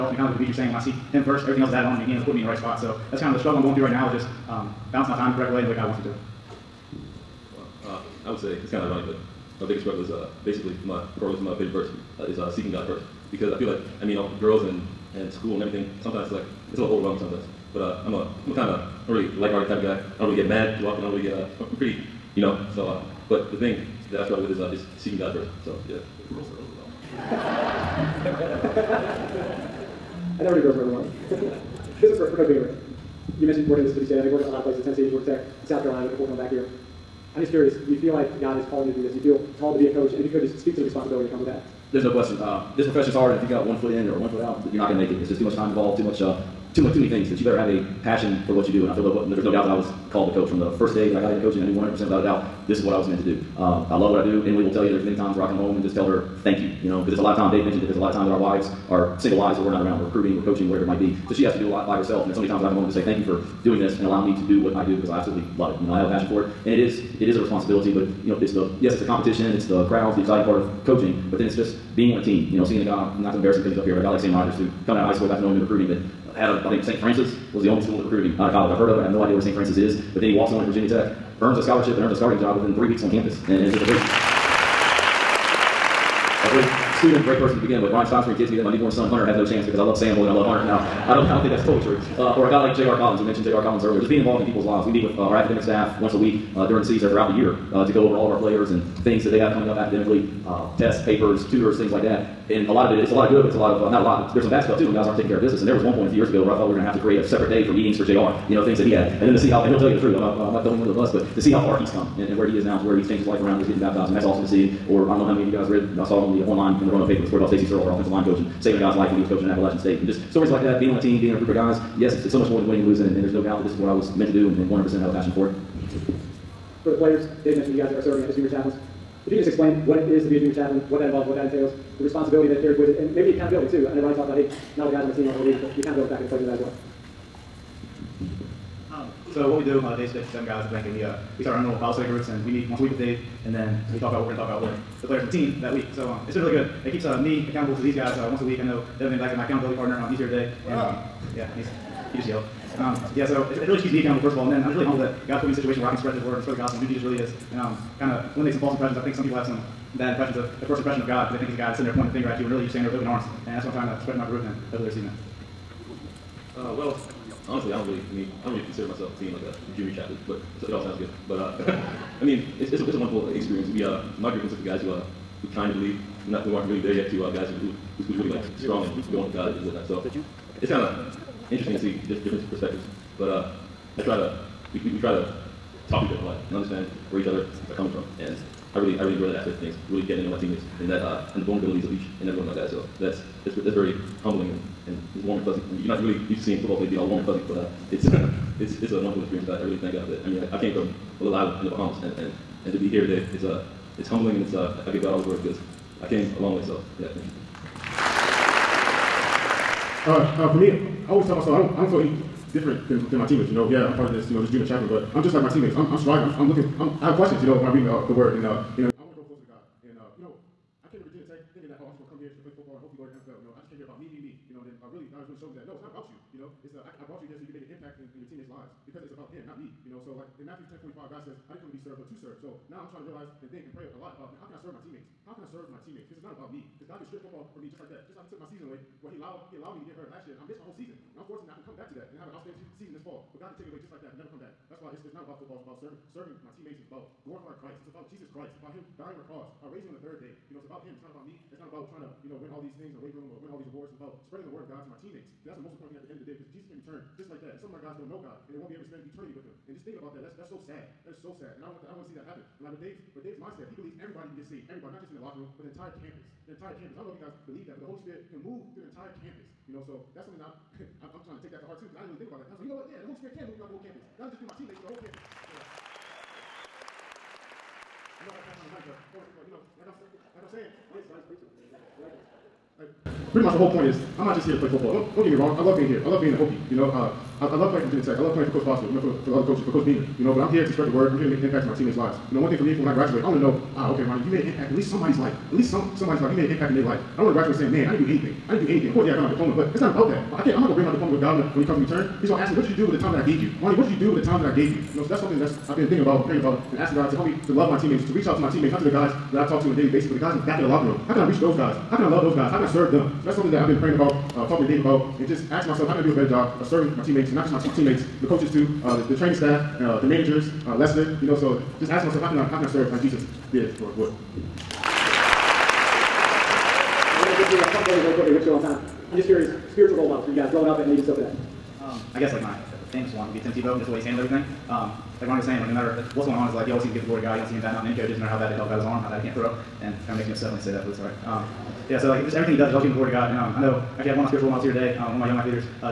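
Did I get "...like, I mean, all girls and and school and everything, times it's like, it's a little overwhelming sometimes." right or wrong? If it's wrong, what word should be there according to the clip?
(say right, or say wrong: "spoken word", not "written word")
wrong: "sometimes", not "times".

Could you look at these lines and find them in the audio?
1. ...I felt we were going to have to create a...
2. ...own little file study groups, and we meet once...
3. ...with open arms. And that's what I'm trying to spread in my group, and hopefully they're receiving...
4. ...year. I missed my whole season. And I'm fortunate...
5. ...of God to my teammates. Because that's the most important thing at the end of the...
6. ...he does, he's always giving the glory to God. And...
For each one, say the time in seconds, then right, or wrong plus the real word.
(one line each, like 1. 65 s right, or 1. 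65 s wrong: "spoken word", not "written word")
1. 106 s right
2. 141 s right
3. 162 s right
4. 240 s right
5. 254 s right
6. 342 s right.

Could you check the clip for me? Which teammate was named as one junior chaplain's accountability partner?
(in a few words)
Devin Van Dyke.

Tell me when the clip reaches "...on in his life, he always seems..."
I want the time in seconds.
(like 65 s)
336 s.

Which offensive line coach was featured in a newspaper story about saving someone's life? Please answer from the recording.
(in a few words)
Stacy Searels.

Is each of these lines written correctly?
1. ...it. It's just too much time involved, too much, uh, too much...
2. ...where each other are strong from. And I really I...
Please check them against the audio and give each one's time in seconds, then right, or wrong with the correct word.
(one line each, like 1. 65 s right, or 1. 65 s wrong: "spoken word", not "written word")
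1. 45 s right
2. 187 s wrong: "coming", not "strong".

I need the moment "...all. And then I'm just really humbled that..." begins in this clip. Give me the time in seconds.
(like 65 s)
154 s.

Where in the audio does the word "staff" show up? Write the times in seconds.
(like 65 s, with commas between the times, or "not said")
95 s, 319 s.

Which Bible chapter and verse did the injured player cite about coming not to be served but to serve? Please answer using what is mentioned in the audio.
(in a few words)
Matthew 10:45.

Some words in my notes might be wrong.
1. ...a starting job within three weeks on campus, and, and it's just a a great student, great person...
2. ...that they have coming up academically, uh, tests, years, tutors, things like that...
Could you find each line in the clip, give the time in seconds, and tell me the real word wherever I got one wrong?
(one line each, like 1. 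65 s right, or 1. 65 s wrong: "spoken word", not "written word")
1. 82 s right
2. 99 s wrong: "papers", not "years".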